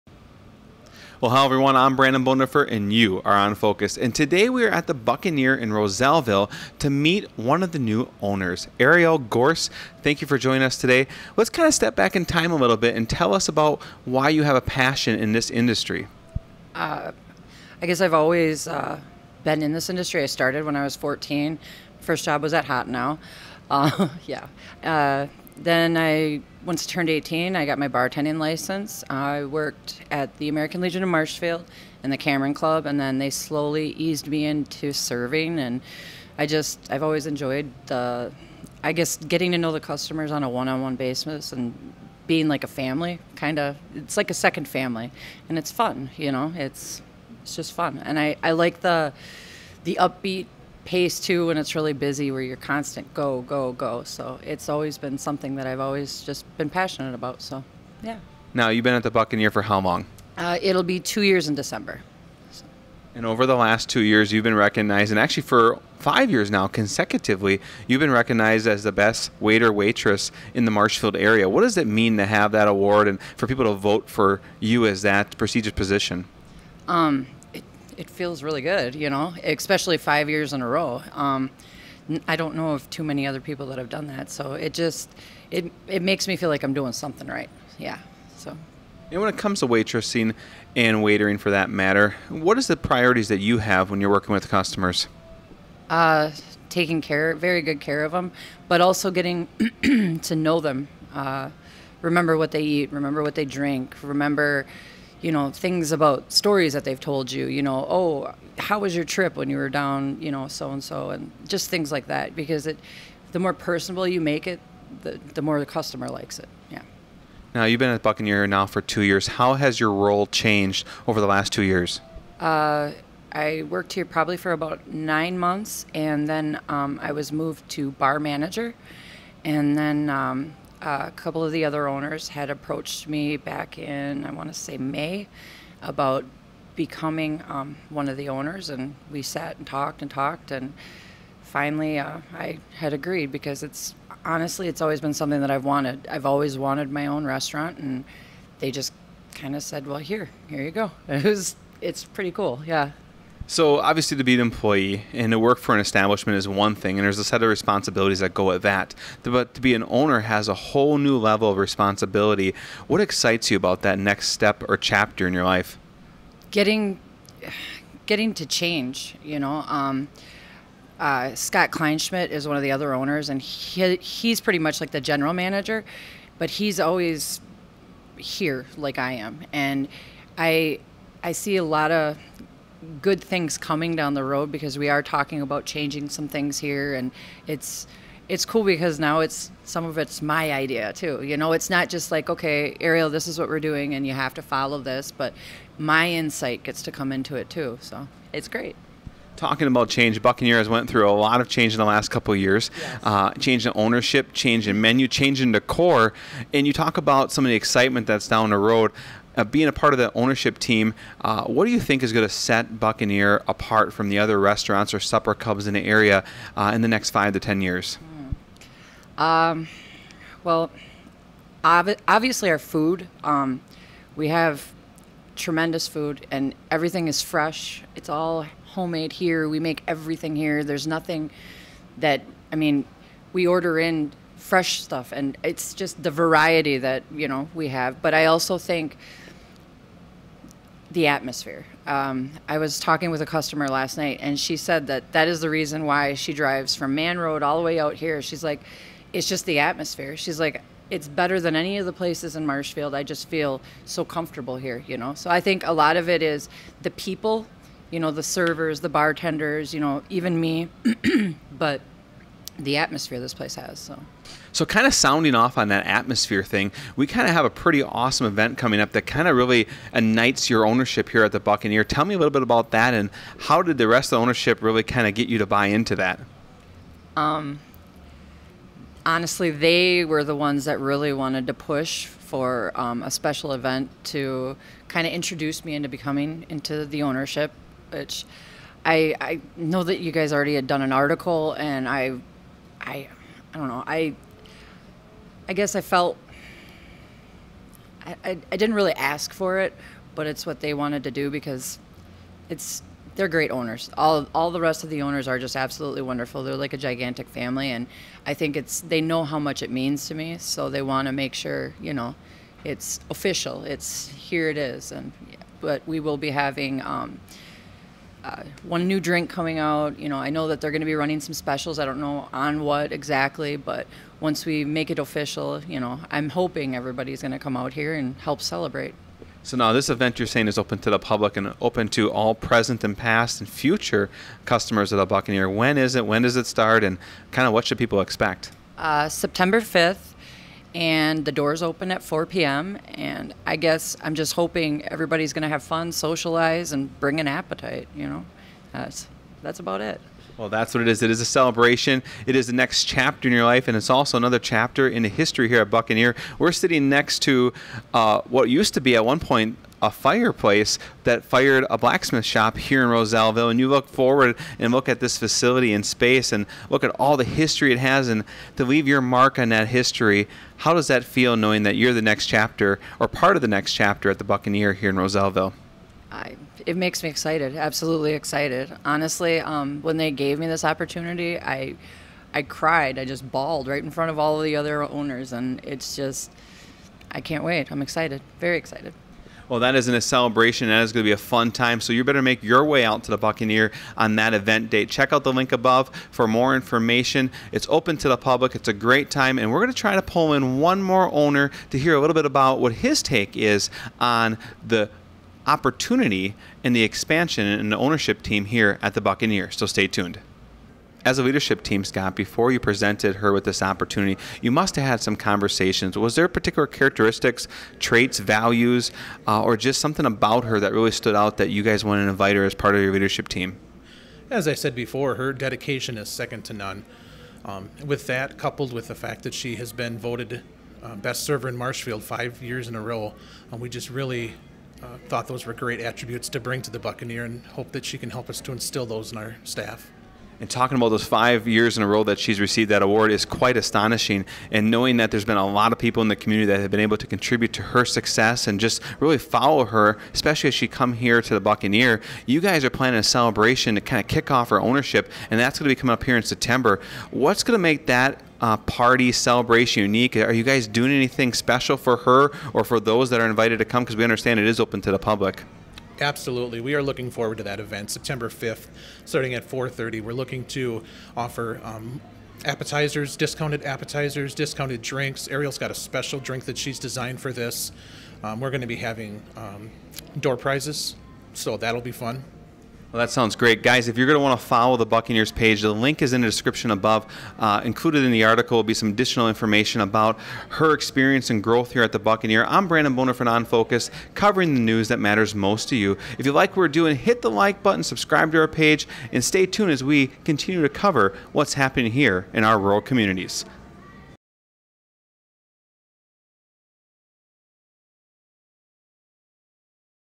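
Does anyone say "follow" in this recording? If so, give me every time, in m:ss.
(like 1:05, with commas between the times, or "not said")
3:14, 7:29, 8:04.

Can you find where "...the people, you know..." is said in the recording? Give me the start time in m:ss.
4:16.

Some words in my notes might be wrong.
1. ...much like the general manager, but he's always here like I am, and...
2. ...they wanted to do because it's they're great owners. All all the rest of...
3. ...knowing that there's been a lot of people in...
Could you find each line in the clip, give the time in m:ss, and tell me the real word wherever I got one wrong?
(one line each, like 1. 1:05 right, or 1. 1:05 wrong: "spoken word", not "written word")
1. 2:54 right
2. 5:00 right
3. 7:24 right.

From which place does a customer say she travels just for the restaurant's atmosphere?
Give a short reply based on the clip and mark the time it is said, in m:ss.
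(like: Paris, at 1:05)
Man Road, at 4:06.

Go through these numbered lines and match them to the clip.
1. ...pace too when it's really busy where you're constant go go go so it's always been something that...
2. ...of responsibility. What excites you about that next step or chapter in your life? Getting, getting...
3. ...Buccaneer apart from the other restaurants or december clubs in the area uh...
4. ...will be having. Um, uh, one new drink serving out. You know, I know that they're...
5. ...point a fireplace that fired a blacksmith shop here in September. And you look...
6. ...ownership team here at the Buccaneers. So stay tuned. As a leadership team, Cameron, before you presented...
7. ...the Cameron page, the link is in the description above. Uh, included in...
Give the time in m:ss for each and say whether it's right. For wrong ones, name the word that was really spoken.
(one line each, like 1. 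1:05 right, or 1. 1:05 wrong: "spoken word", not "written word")
1. 0:50 right
2. 2:41 right
3. 3:32 wrong: "supper", not "december"
4. 5:15 wrong: "coming", not "serving"
5. 5:59 wrong: "Rozellville", not "September"
6. 6:47 wrong: "Scott", not "Cameron"
7. 8:04 wrong: "Buccaneers", not "Cameron".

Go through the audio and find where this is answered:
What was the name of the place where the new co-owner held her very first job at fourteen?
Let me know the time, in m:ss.
0:22.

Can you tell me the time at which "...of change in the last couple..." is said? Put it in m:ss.
3:21.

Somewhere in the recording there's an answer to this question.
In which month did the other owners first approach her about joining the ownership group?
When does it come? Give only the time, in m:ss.
2:14.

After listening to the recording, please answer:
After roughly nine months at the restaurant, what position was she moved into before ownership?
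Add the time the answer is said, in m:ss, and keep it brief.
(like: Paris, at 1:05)
Bar manager, at 2:07.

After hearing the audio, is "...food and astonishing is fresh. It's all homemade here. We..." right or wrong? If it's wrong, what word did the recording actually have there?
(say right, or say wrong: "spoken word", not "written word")
wrong: "everything", not "astonishing".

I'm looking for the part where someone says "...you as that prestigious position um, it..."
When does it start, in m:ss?
1:14.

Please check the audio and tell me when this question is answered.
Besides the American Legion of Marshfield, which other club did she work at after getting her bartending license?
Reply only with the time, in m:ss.
0:32.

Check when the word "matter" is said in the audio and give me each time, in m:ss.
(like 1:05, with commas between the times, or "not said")
1:31, 8:14.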